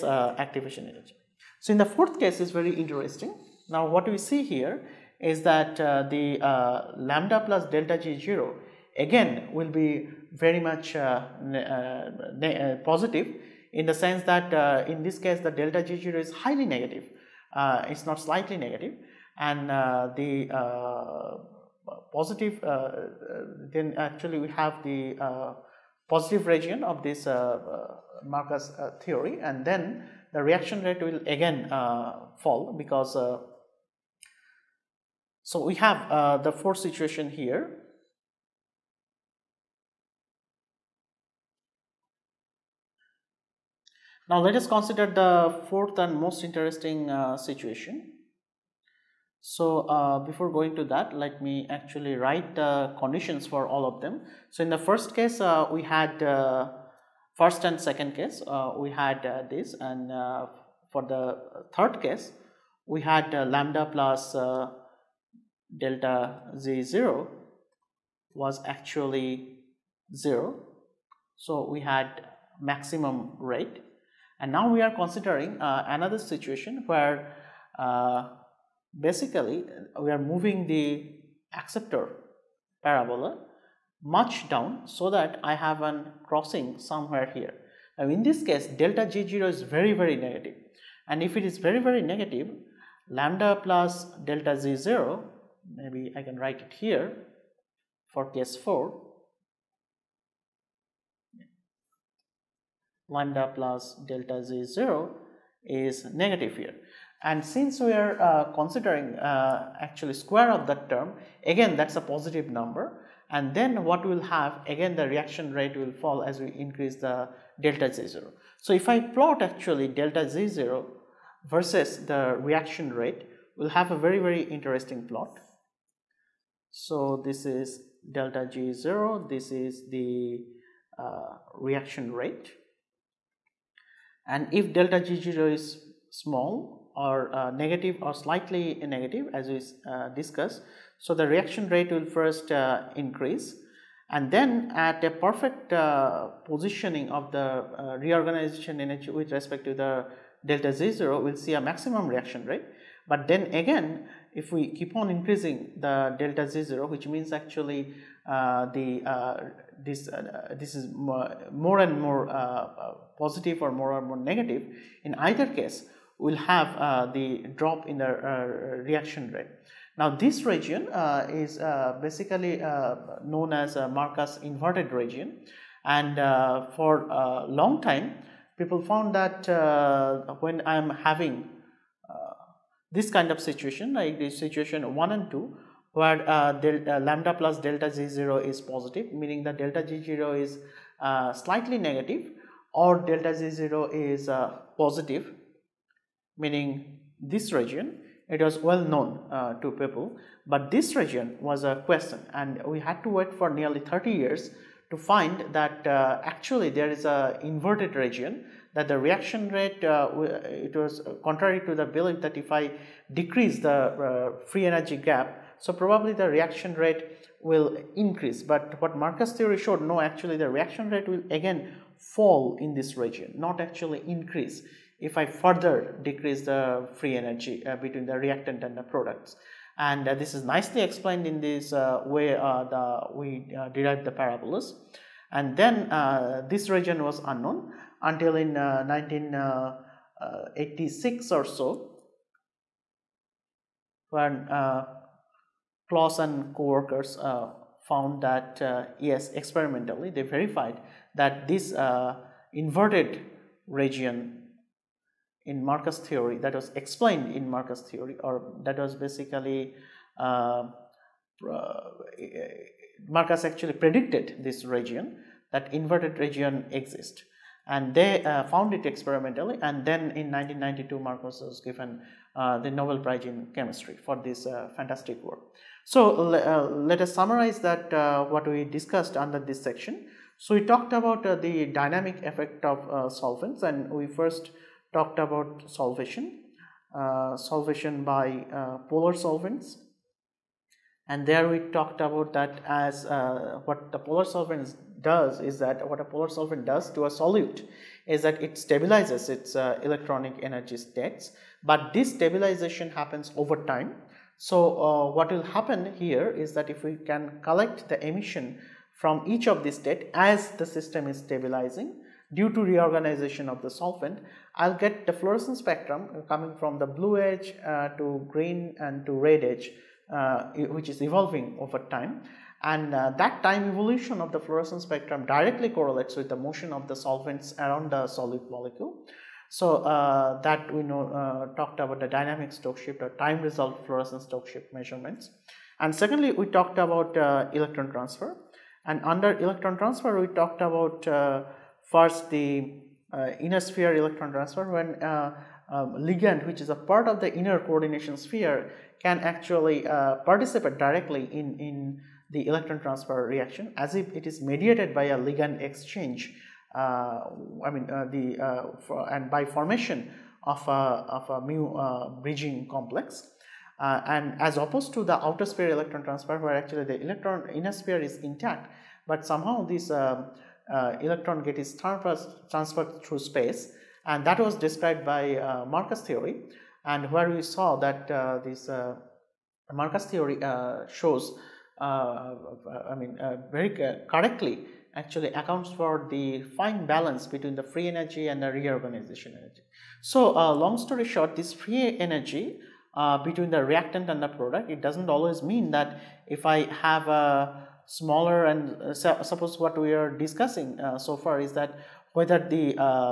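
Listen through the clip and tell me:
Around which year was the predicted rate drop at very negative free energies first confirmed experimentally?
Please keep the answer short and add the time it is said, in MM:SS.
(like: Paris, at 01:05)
1986, at 03:58.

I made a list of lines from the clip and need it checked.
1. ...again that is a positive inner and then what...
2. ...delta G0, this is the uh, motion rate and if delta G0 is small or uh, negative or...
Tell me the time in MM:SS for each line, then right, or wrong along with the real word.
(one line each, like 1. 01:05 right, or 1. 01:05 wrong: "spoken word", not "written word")
1. 01:51 wrong: "number", not "inner"
2. 02:08 wrong: "reaction", not "motion".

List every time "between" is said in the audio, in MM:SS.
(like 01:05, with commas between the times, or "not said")
03:47, 06:27, 06:33.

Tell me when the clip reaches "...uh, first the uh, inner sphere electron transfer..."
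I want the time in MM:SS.
05:41.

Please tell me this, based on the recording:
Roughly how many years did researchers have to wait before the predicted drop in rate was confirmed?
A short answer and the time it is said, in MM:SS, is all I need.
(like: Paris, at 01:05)
30 years, at 03:23.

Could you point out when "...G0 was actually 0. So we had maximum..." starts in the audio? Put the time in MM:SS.
01:06.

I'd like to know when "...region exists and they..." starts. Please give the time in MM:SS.
04:26.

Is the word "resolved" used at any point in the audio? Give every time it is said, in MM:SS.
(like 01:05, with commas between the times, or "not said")
05:33.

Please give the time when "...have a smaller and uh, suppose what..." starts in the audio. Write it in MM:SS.
06:36.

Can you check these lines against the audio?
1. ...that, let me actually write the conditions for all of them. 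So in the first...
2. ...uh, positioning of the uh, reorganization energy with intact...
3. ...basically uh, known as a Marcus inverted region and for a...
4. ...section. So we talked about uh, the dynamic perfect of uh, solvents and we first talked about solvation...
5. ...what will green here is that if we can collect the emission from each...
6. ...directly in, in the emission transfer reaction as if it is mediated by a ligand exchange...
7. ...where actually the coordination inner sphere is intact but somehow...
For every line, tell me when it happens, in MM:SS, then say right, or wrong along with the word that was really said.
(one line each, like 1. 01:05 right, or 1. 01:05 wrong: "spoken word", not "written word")
1. 00:50 right
2. 02:25 wrong: "respect", not "intact"
3. 02:52 right
4. 04:39 wrong: "effect", not "perfect"
5. 05:05 wrong: "happen", not "green"
6. 05:50 wrong: "electron", not "emission"
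7. 06:06 wrong: "electron", not "coordination".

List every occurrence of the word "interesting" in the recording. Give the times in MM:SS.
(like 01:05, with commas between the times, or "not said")
00:02, 00:46, 02:04.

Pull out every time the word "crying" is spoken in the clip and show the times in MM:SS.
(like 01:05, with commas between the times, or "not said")
not said.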